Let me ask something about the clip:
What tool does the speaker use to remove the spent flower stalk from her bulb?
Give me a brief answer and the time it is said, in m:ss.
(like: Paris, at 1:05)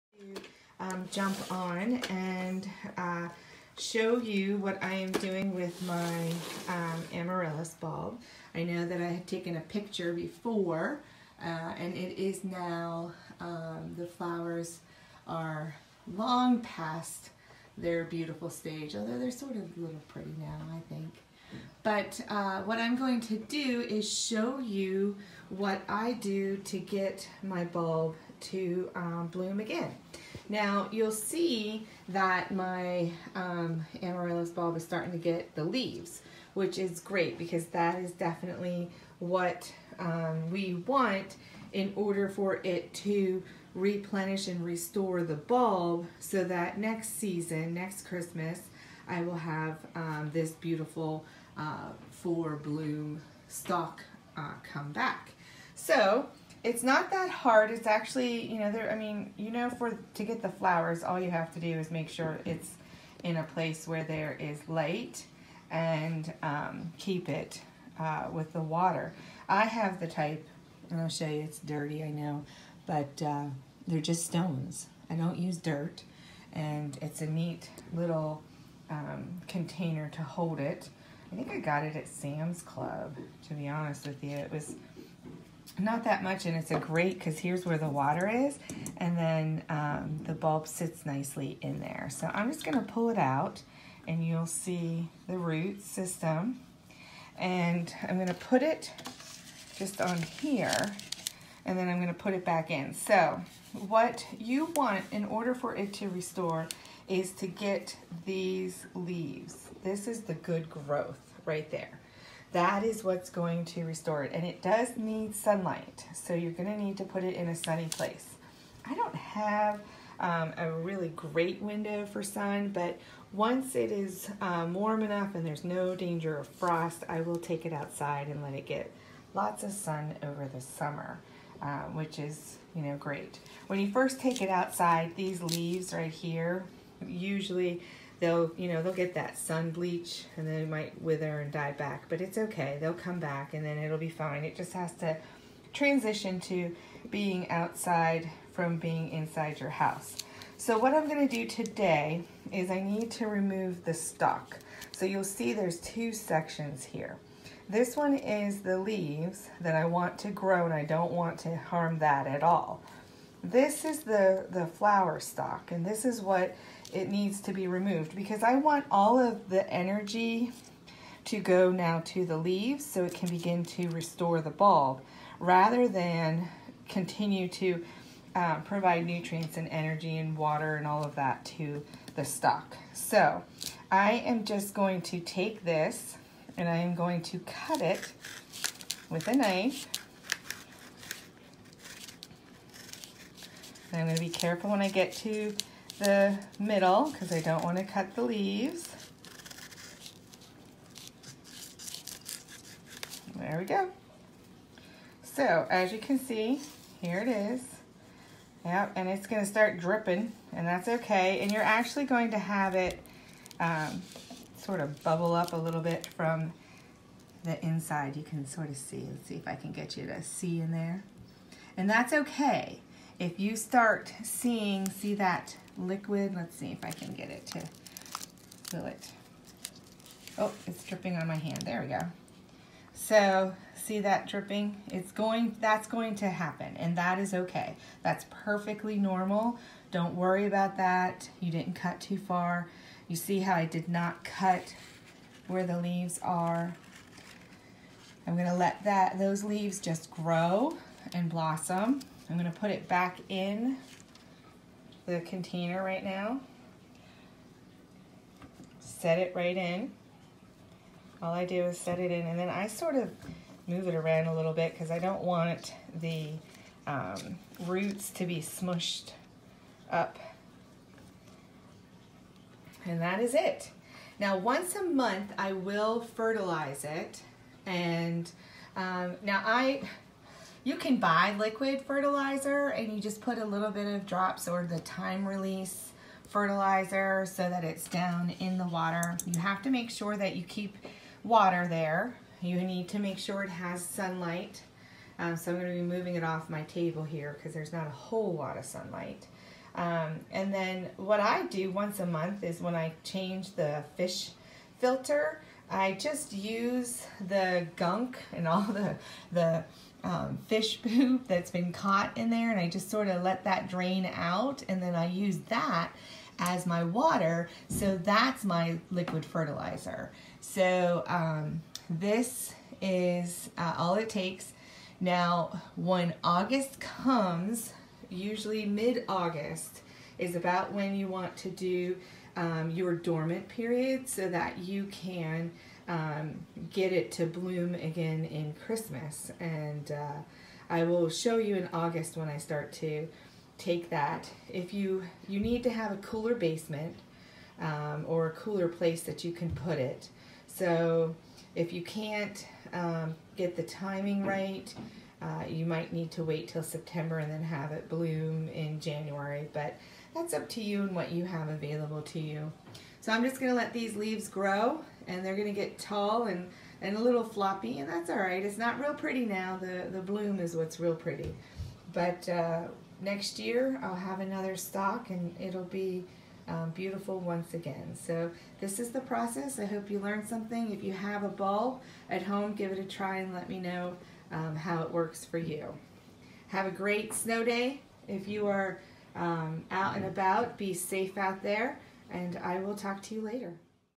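A knife, at 3:09.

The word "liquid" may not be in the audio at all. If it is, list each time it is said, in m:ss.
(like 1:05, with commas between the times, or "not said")
3:45, 4:41, 5:18.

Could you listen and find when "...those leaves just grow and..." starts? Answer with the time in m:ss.
4:09.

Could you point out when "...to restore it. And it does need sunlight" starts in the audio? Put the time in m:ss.
1:53.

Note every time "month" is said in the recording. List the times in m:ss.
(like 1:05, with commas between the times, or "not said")
4:34, 5:02.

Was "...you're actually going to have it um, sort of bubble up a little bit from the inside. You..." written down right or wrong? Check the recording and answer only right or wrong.
right.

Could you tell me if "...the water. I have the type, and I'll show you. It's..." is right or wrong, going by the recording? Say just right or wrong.
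right.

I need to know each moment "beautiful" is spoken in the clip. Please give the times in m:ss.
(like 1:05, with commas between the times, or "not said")
0:18, 0:50, 6:16.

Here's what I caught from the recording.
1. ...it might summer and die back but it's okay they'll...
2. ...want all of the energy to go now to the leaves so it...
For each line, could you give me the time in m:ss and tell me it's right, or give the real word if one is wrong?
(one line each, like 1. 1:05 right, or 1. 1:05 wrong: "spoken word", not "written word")
1. 2:20 wrong: "wither", not "summer"
2. 2:48 right.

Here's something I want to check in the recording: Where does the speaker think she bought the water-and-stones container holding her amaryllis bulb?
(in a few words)
Sam's Club.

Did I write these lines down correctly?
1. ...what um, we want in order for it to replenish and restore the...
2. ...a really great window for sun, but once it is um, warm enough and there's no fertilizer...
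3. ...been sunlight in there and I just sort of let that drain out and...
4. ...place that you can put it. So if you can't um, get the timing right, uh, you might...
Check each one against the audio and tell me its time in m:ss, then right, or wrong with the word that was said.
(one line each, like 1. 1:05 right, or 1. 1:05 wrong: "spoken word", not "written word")
1. 0:39 right
2. 2:00 wrong: "danger", not "fertilizer"
3. 5:11 wrong: "caught", not "sunlight"
4. 5:48 right.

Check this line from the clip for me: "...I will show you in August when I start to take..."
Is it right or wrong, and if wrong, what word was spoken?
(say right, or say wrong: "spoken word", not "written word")
right.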